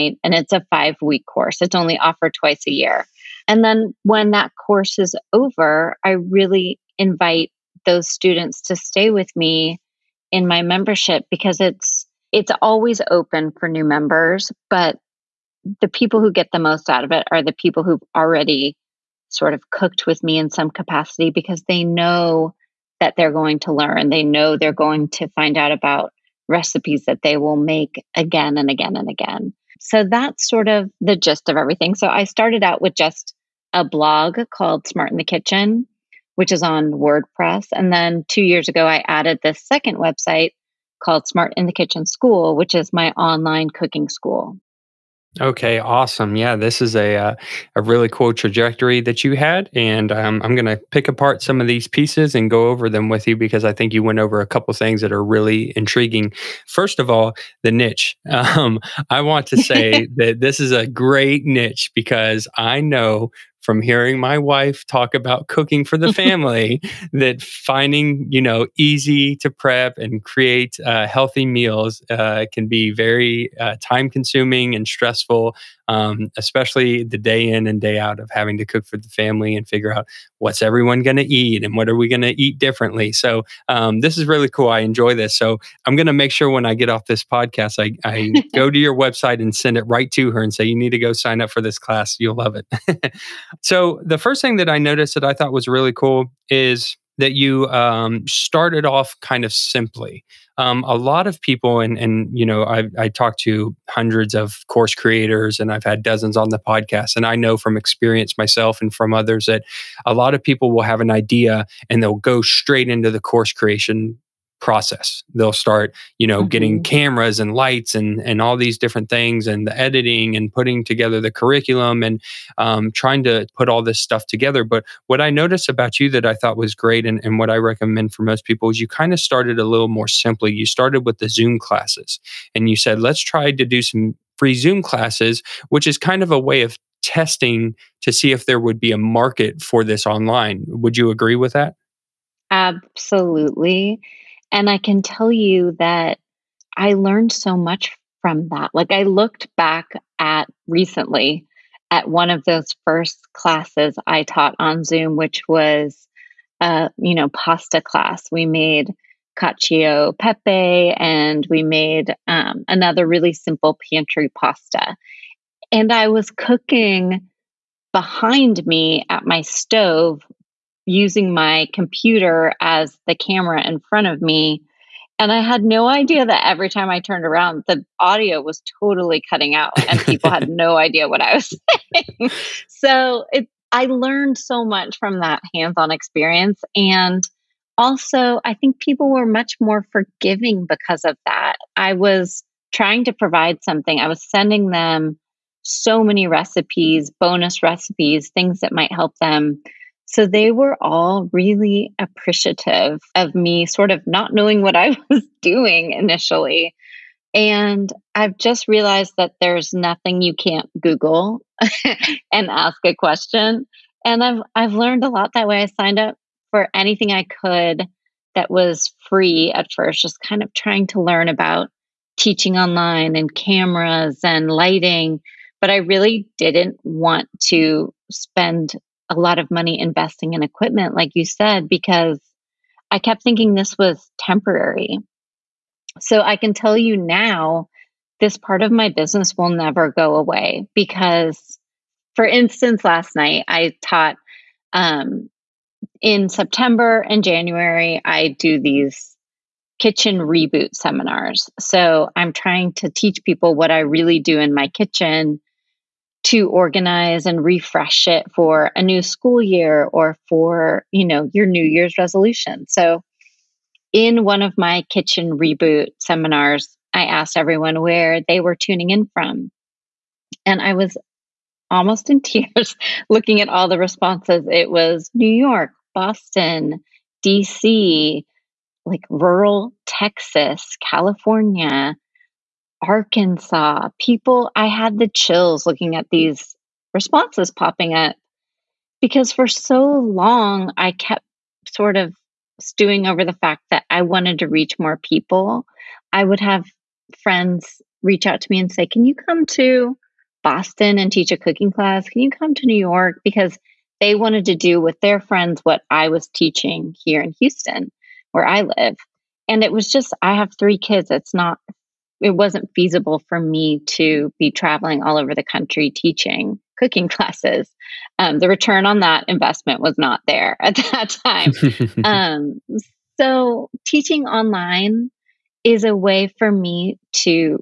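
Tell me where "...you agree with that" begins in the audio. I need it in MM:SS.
02:20.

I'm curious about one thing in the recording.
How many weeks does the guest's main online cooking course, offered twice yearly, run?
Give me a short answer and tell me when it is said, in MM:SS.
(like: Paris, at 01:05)
5, at 00:00.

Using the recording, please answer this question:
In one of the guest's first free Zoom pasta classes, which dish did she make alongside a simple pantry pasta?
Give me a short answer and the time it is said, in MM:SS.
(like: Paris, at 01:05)
Cacio pepe, at 02:39.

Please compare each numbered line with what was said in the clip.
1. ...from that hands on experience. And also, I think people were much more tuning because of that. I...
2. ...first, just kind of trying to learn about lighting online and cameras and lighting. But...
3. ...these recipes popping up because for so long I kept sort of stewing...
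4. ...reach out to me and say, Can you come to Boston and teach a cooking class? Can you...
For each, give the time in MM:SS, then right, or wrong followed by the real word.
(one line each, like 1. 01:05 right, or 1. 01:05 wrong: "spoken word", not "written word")
1. 03:04 wrong: "forgiving", not "tuning"
2. 03:39 wrong: "teaching", not "lighting"
3. 04:46 wrong: "responses", not "recipes"
4. 04:58 right.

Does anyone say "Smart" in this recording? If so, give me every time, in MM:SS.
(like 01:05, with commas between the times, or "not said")
00:34, 00:41.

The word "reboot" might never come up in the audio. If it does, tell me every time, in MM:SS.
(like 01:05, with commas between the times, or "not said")
04:10, 04:25.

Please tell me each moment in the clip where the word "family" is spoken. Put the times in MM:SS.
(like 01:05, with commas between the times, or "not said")
01:06, 01:19.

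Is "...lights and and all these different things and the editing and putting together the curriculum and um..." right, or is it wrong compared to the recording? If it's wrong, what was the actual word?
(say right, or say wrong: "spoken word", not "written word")
right.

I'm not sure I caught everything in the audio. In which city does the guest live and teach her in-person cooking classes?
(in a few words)
Houston.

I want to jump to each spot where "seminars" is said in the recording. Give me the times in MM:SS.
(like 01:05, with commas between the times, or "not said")
04:10, 04:25.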